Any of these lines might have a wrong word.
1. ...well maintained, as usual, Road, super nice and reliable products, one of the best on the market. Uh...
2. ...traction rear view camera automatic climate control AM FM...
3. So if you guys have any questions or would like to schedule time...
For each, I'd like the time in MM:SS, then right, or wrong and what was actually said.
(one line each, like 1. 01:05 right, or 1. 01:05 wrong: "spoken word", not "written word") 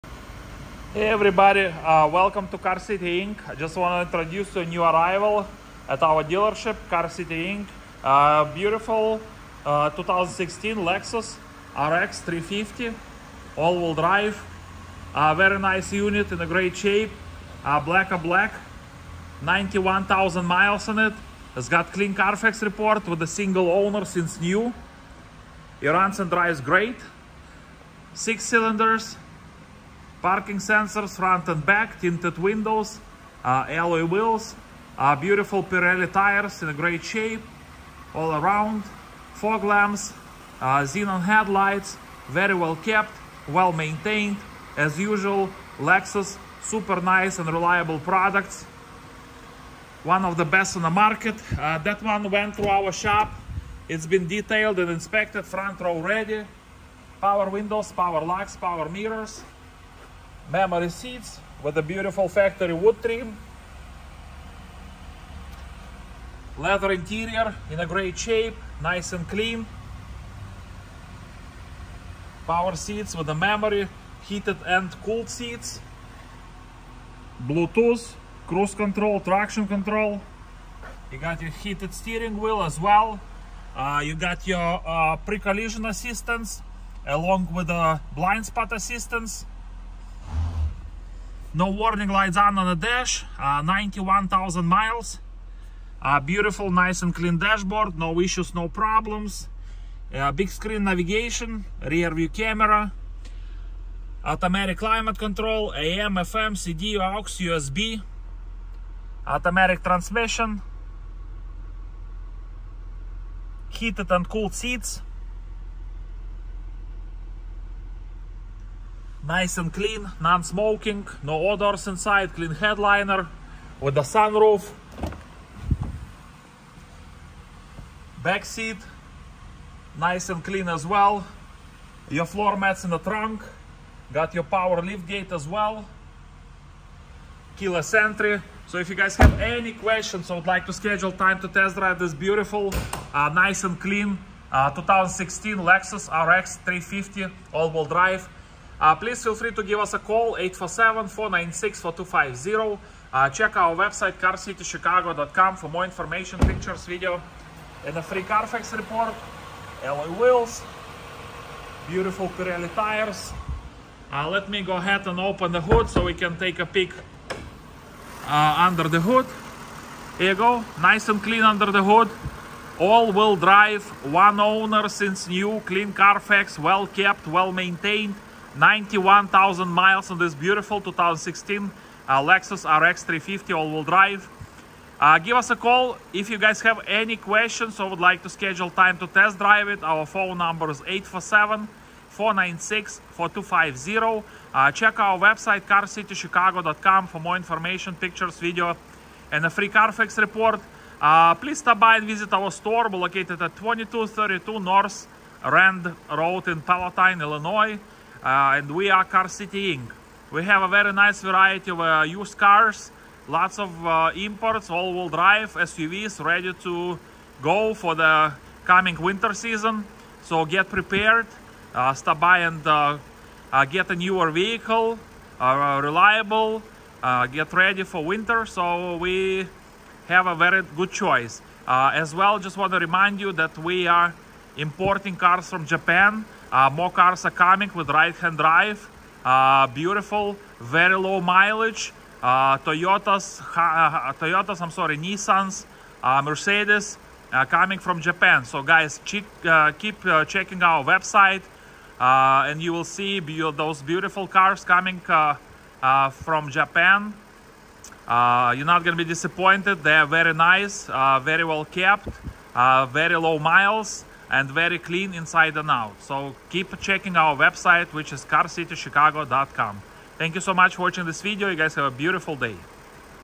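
1. 00:43 wrong: "Lexus", not "Road"
2. 01:40 wrong: "navigation", not "traction"
3. 02:18 right.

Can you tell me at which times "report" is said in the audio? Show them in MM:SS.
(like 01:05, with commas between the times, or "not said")
00:22, 02:38, 03:20.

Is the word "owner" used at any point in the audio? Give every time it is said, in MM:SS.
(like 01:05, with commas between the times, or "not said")
00:23, 02:54.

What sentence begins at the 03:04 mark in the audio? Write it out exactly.
Uh, give us a call if you guys have any questions or would like to schedule time to test drive it.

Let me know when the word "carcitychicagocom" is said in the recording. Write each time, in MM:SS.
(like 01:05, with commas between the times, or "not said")
02:34, 03:15, 04:28.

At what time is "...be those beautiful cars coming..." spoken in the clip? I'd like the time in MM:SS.
04:13.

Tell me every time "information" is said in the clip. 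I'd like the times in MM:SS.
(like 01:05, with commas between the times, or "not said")
02:35, 03:17.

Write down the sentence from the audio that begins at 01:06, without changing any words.
Leather interior in a great shape, nice and clean.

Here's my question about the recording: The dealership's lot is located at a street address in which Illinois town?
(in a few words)
Palatine.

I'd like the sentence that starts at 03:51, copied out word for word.
Uh, as well, just want to remind you that we are importing cars from Japan.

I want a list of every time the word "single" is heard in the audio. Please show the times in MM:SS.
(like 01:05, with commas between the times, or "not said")
00:23.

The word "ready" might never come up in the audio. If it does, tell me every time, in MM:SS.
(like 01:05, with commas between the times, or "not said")
00:55, 03:36, 03:47.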